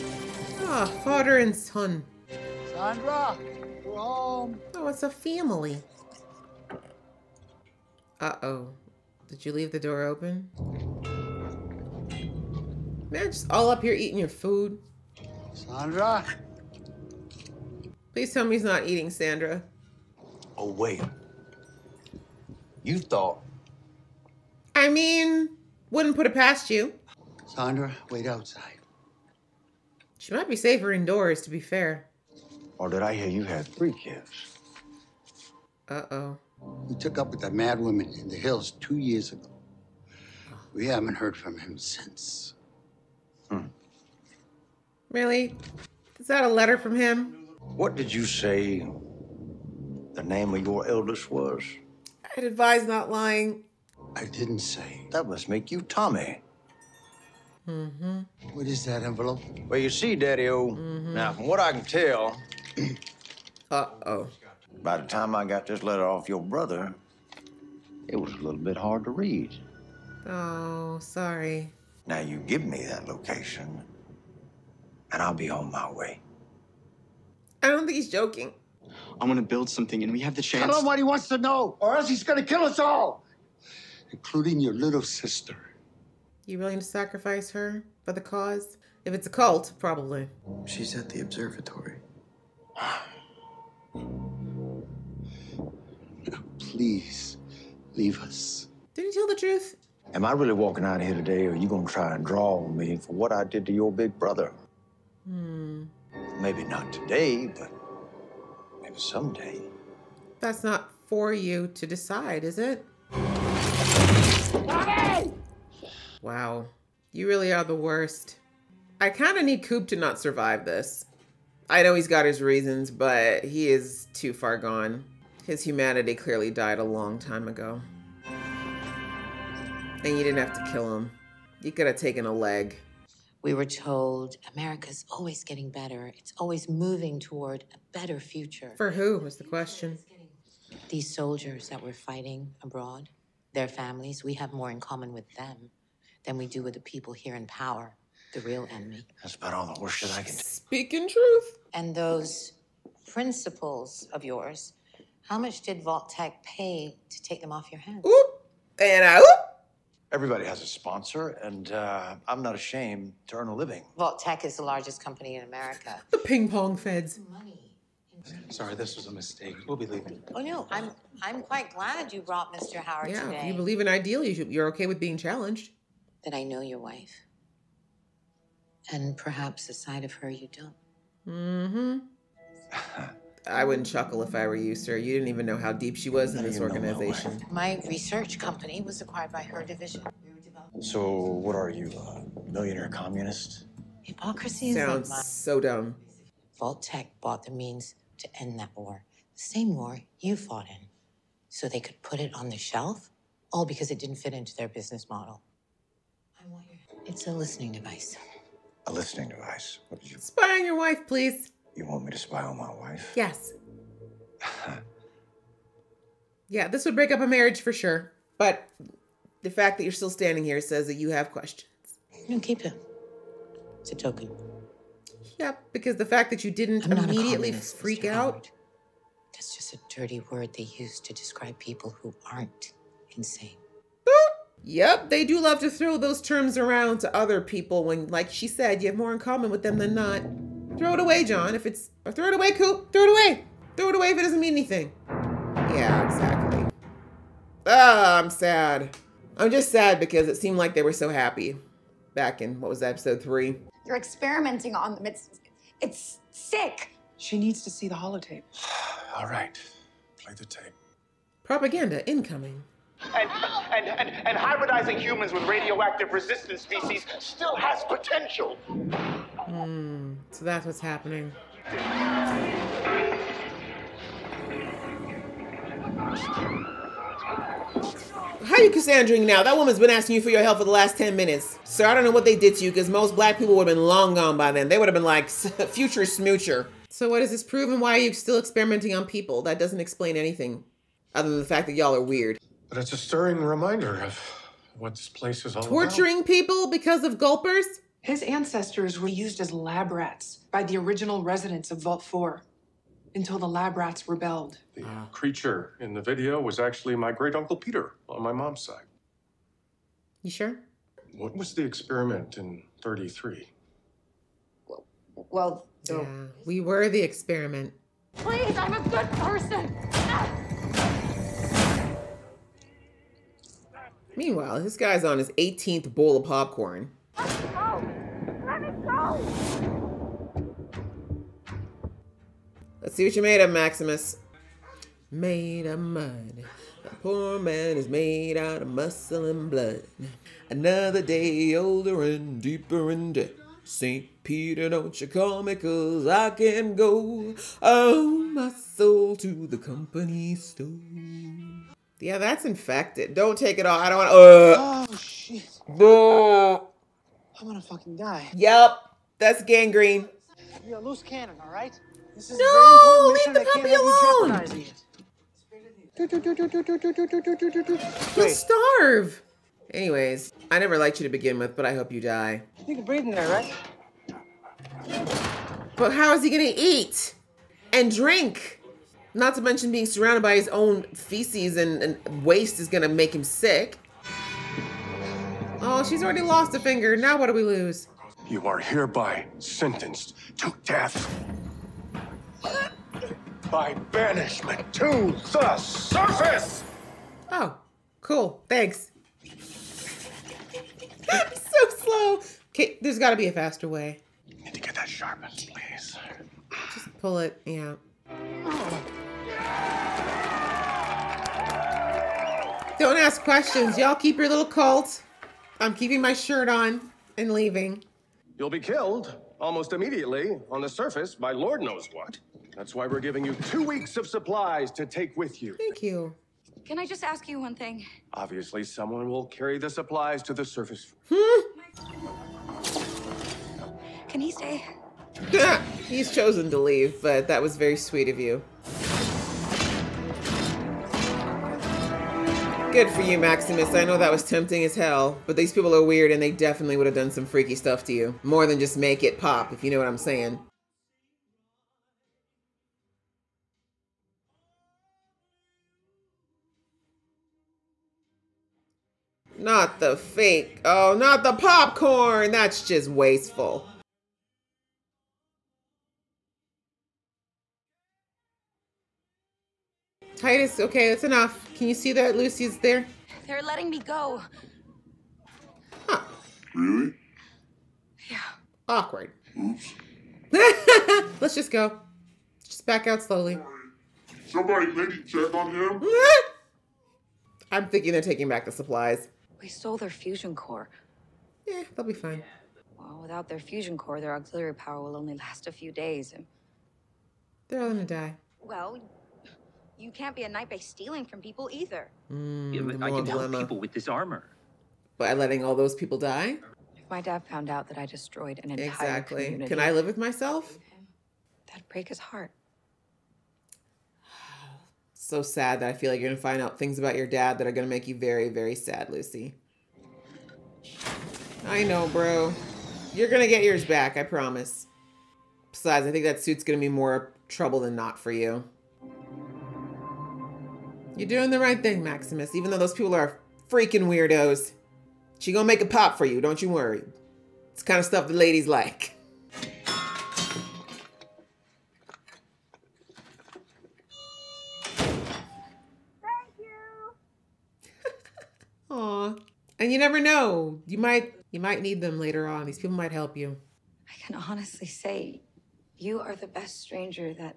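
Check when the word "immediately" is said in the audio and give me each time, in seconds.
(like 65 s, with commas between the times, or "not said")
226 s, 419 s.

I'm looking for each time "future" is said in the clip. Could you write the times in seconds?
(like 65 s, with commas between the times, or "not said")
138 s, 285 s.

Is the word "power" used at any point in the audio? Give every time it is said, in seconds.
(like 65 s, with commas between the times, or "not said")
147 s, 494 s.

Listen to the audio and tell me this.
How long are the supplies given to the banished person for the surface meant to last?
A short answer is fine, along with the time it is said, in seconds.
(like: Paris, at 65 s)
2 weeks, at 423 s.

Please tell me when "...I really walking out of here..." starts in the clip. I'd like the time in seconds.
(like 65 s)
100 s.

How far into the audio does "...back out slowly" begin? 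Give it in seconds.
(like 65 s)
482 s.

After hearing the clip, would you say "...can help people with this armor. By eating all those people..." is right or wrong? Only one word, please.
wrong.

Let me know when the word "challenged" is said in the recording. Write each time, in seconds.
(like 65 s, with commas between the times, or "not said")
175 s.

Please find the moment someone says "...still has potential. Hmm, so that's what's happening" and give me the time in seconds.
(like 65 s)
267 s.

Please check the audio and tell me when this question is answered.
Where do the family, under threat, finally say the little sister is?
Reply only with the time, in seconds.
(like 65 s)
91 s.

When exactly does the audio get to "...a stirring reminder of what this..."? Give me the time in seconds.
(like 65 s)
292 s.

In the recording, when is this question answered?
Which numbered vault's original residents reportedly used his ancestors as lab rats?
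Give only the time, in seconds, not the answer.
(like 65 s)
301 s.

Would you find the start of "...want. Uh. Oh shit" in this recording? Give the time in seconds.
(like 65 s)
353 s.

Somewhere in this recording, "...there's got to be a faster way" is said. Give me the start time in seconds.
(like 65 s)
402 s.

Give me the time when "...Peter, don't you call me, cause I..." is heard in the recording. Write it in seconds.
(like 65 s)
344 s.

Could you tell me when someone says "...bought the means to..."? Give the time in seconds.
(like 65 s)
197 s.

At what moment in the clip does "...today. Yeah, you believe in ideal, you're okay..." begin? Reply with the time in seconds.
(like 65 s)
173 s.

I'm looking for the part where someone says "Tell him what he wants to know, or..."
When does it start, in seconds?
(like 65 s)
80 s.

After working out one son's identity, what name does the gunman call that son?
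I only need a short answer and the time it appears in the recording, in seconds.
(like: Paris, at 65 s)
Tommy, at 55 s.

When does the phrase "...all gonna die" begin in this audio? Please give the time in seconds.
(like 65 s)
497 s.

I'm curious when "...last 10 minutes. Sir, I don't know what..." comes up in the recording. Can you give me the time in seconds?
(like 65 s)
280 s.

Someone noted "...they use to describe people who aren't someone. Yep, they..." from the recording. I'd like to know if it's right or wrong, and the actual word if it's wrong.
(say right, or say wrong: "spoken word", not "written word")
wrong: "insane", not "someone".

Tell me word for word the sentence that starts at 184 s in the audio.
You didn't even know how deep she was in this organization.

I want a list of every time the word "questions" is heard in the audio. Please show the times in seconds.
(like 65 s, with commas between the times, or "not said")
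139 s, 221 s, 413 s.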